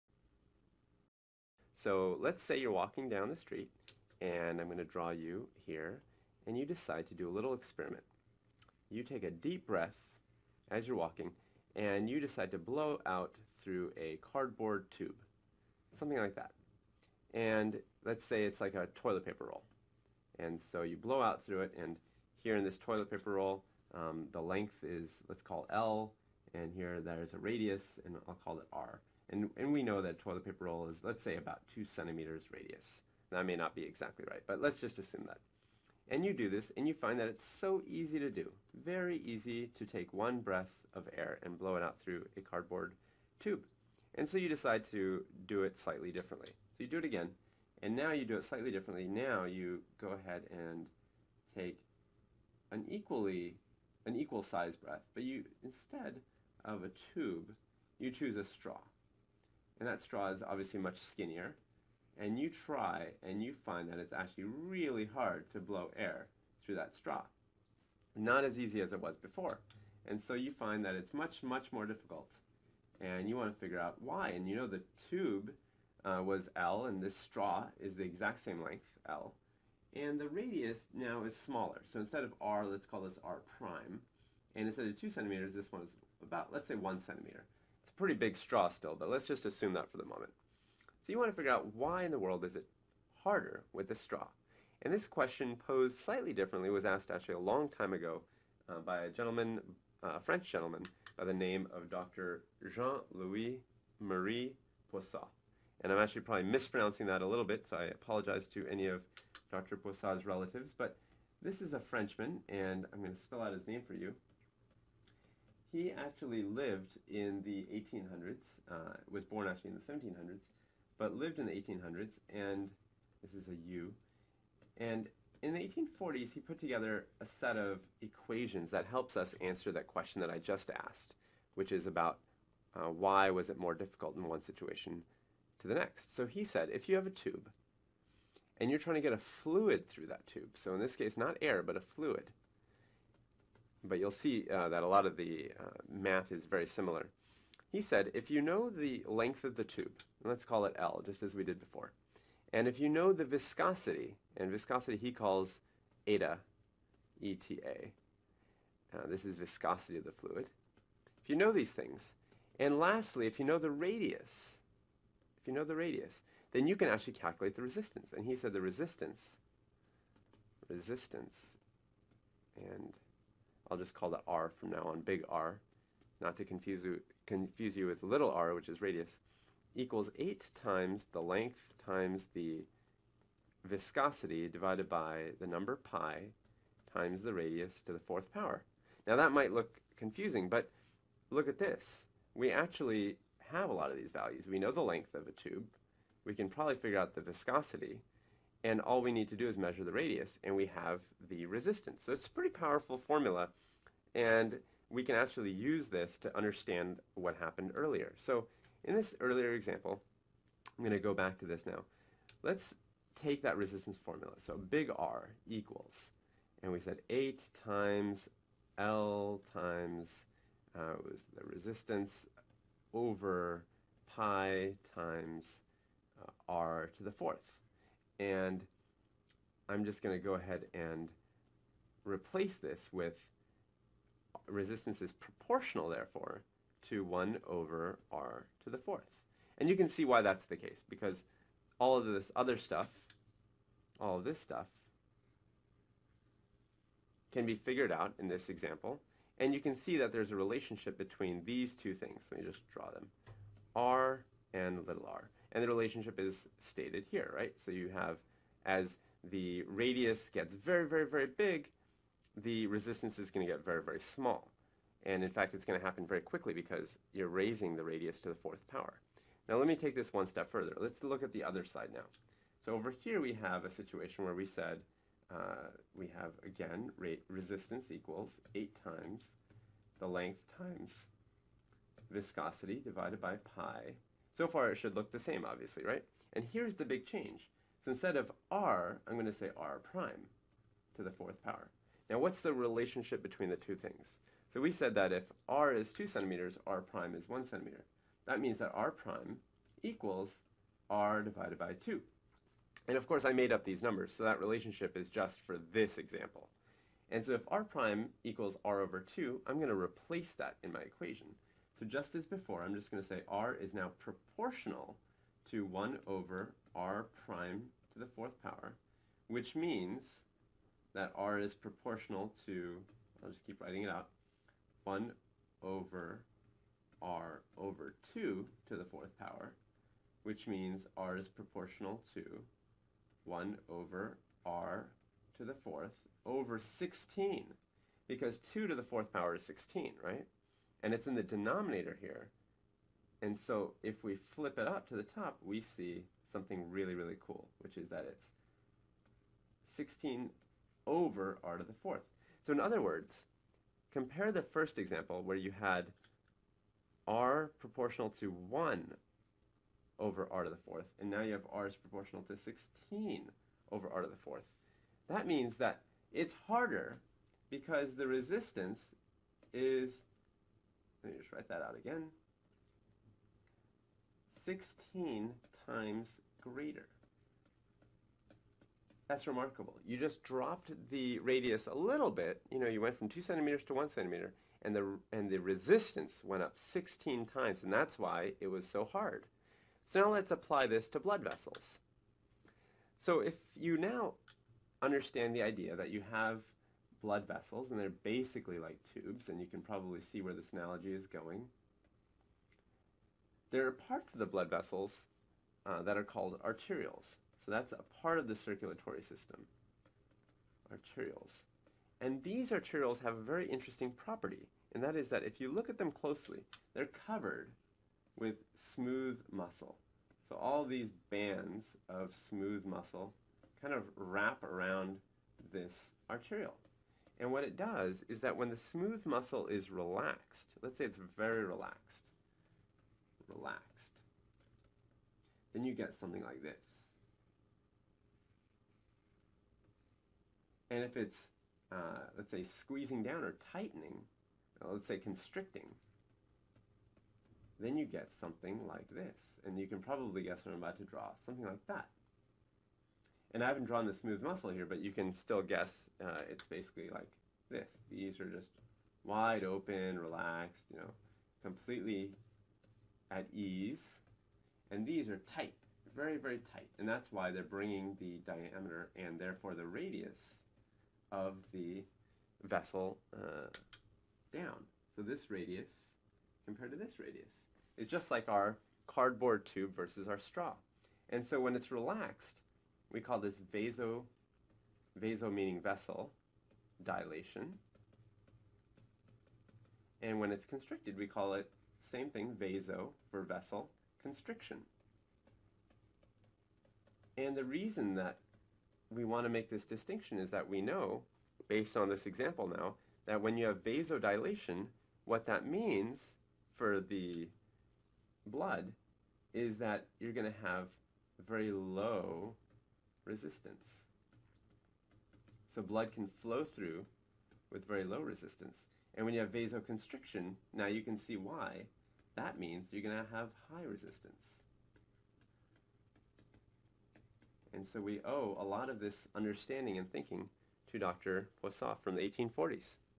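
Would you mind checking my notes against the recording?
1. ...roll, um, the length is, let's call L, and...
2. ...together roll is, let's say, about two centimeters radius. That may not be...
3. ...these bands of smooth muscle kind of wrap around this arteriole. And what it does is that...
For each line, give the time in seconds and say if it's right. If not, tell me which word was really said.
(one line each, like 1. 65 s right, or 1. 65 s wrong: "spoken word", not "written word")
1. 23 s right
2. 30 s wrong: "paper", not "together"
3. 420 s right.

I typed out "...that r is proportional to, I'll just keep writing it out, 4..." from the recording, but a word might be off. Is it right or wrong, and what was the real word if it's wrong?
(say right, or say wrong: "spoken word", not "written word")
wrong: "1", not "4".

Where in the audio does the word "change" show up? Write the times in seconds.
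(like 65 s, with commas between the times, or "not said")
287 s.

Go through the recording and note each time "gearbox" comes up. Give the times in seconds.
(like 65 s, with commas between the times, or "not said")
not said.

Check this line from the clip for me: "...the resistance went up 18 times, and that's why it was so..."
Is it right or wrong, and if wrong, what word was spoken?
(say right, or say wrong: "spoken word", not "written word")
wrong: "16", not "18".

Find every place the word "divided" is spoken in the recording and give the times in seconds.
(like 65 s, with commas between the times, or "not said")
184 s, 282 s, 301 s.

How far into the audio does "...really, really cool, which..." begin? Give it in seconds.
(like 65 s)
346 s.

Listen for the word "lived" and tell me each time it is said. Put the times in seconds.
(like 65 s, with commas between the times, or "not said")
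116 s, 121 s.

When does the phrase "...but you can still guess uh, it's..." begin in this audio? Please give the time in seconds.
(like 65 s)
454 s.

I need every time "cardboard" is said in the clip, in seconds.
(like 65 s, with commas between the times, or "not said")
14 s, 42 s, 478 s.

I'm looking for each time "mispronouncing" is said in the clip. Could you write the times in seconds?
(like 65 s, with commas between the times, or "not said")
106 s.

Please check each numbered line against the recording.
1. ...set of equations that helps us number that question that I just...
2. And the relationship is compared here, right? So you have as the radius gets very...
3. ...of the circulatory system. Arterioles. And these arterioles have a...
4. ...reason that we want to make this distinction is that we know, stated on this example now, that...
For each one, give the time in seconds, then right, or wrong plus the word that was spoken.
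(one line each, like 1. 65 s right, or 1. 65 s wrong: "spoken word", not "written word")
1. 127 s wrong: "answer", not "number"
2. 255 s wrong: "stated", not "compared"
3. 408 s right
4. 497 s wrong: "based", not "stated".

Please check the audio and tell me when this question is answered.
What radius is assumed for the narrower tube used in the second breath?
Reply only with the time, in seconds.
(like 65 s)
86 s.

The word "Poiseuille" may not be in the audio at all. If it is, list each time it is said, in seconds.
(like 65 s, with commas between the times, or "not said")
104 s, 109 s, 531 s.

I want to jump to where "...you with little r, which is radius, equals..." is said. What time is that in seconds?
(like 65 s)
177 s.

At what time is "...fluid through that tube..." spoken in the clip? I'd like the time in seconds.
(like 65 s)
139 s.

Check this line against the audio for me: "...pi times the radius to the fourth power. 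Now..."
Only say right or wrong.
right.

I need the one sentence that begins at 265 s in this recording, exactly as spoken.
And in fact, it's going to happen very quickly because you're raising the radius to the fourth power.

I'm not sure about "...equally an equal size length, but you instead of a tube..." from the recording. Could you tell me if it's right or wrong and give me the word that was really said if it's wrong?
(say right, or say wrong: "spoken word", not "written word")
wrong: "breath", not "length".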